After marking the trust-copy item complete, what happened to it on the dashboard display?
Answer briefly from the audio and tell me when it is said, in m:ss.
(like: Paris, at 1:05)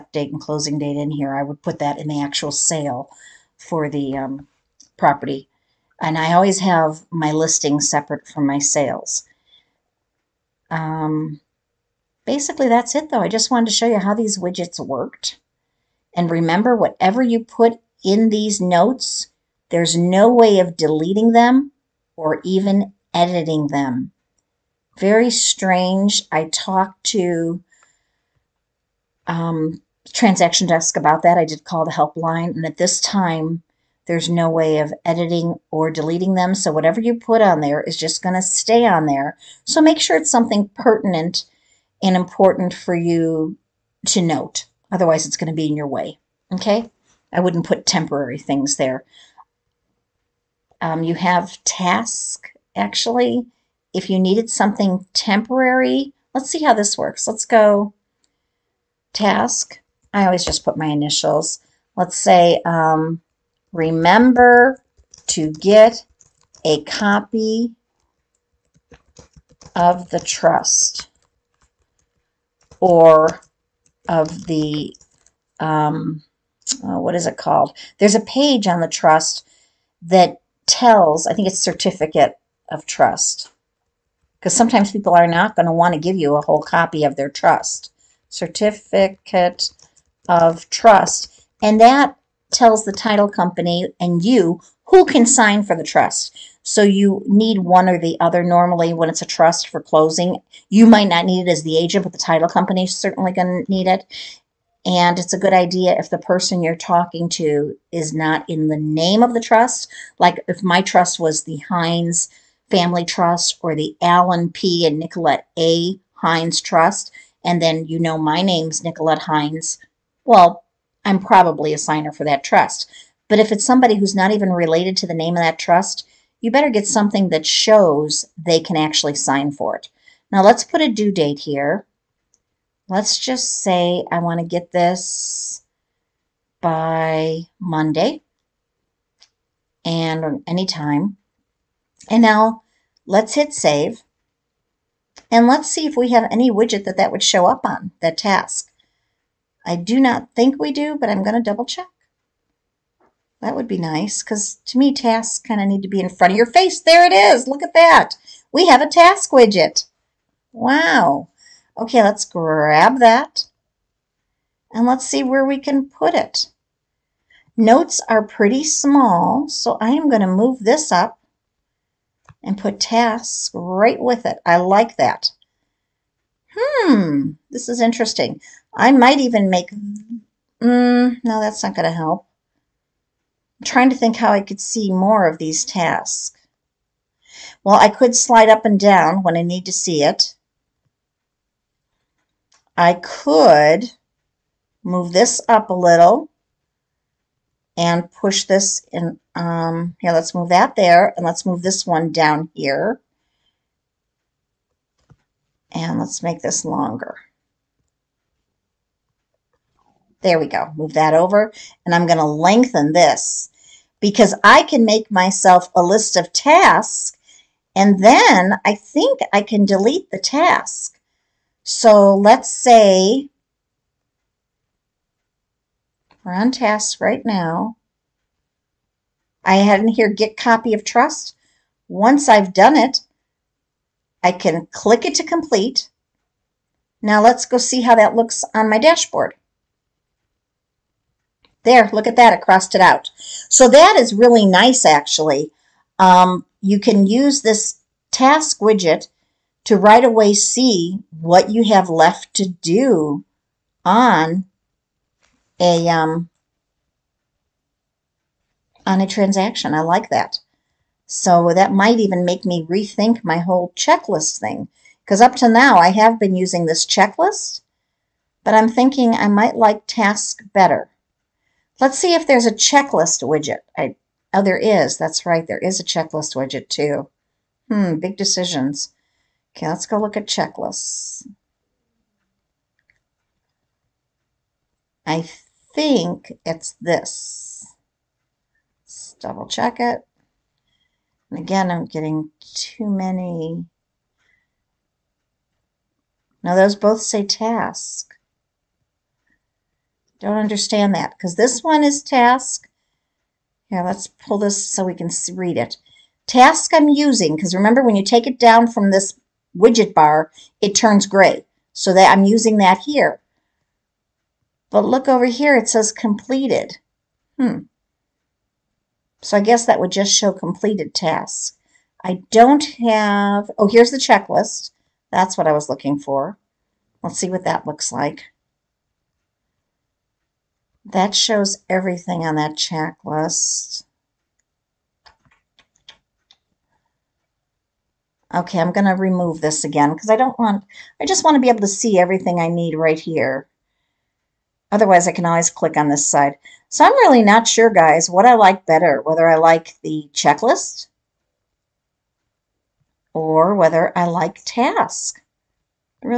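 Crossed it out, at 4:02.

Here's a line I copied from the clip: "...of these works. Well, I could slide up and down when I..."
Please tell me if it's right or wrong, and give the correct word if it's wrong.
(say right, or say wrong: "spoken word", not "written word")
wrong: "tasks", not "works".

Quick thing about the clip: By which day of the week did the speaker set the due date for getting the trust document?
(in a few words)
Monday.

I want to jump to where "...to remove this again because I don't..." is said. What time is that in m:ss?
5:38.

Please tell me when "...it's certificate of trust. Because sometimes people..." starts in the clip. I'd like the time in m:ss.
1:21.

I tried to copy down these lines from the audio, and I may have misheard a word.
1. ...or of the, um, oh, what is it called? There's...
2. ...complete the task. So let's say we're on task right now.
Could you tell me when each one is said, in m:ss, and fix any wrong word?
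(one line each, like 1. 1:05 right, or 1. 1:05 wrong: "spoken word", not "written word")
1. 1:12 right
2. 3:39 wrong: "delete", not "complete".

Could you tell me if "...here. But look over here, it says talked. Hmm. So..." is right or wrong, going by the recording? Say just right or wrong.
wrong.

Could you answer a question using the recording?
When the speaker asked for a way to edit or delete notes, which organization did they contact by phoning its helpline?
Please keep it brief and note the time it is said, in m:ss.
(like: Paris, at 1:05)
Transaction Desk, at 0:30.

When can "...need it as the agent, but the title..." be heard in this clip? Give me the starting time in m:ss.
1:41.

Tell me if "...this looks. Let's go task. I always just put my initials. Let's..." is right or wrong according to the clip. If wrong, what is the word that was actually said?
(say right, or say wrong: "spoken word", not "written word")
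wrong: "works", not "looks".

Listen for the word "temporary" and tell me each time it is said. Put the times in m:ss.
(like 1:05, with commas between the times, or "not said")
0:47, 0:55.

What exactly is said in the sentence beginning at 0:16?
And remember, whatever you put in these notes, there's no way of deleting them or even editing them.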